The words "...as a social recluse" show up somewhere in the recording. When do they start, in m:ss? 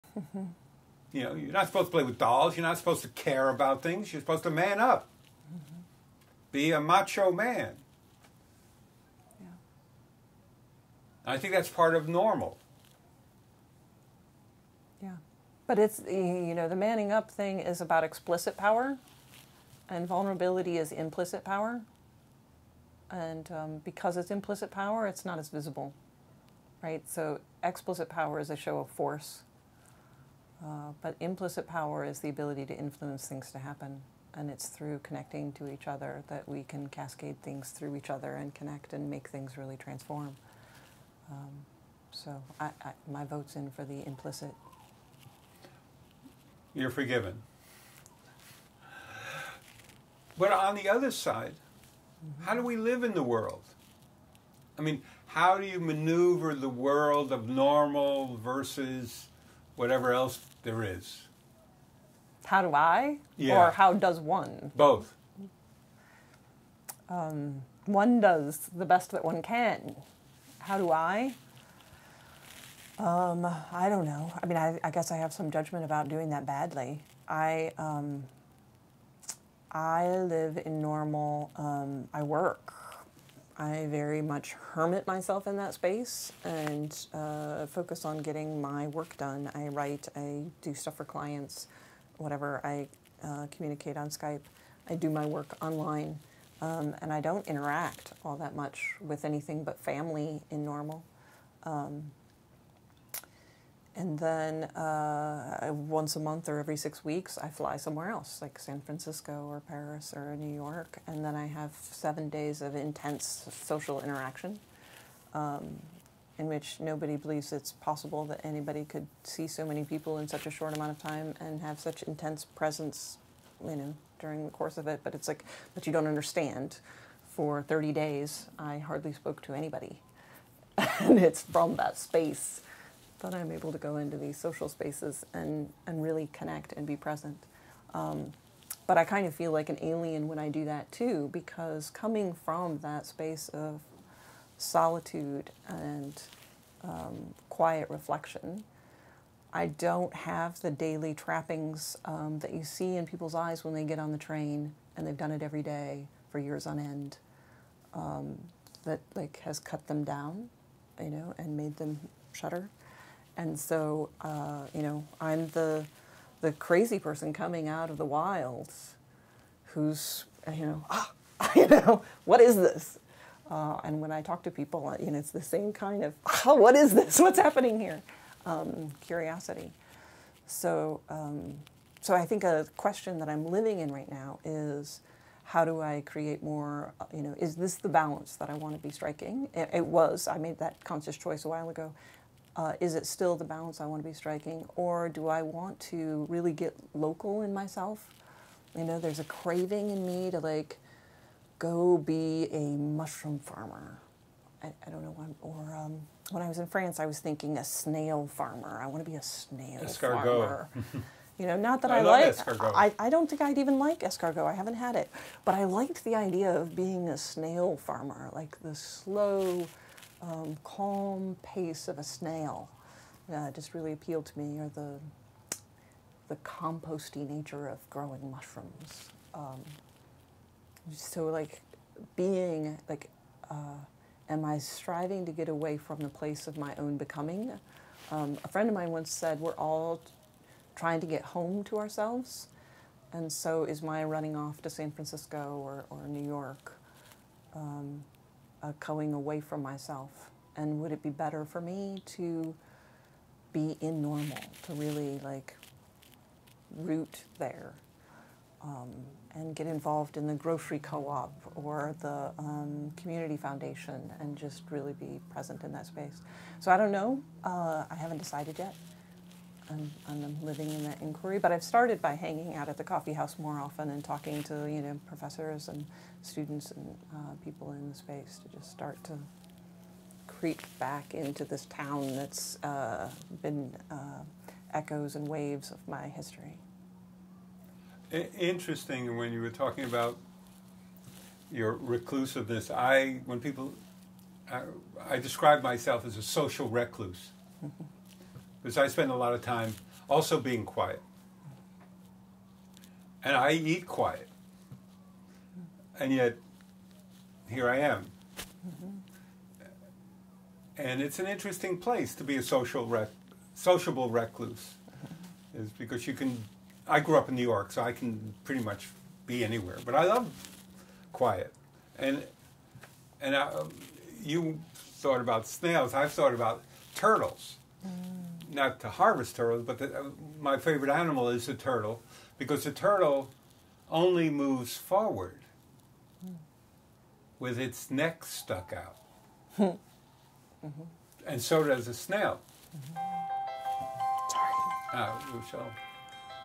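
4:56.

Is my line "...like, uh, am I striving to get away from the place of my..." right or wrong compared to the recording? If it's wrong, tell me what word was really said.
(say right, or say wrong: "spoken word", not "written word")
right.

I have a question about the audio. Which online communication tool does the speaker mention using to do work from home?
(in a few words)
Skype.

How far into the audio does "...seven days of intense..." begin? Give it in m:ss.
1:51.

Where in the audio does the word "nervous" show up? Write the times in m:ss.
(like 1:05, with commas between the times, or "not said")
not said.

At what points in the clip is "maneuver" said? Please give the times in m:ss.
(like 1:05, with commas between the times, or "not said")
0:55.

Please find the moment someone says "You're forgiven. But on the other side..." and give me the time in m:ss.
0:46.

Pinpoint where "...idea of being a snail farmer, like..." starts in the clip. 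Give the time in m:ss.
3:36.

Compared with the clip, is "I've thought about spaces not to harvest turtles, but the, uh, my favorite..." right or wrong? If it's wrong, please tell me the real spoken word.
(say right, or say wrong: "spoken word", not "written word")
wrong: "turtles", not "spaces".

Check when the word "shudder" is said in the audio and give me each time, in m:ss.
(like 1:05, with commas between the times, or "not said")
2:42.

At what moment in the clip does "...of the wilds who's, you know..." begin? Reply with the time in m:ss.
2:47.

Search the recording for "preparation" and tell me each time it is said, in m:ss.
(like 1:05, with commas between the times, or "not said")
not said.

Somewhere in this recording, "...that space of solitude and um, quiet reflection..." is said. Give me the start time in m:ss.
2:22.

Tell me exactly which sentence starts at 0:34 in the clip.
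And it's through connecting to each other that we can cascade things through each other and connect and make things really transform.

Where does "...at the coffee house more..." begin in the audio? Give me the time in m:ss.
4:32.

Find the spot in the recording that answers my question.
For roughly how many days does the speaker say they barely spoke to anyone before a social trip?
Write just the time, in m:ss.
2:07.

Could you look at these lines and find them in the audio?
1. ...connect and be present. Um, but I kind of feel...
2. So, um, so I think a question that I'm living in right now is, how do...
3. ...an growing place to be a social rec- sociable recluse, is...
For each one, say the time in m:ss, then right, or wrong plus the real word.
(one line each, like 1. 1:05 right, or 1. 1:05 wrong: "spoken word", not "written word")
1. 2:16 right
2. 3:00 right
3. 5:11 wrong: "interesting", not "growing".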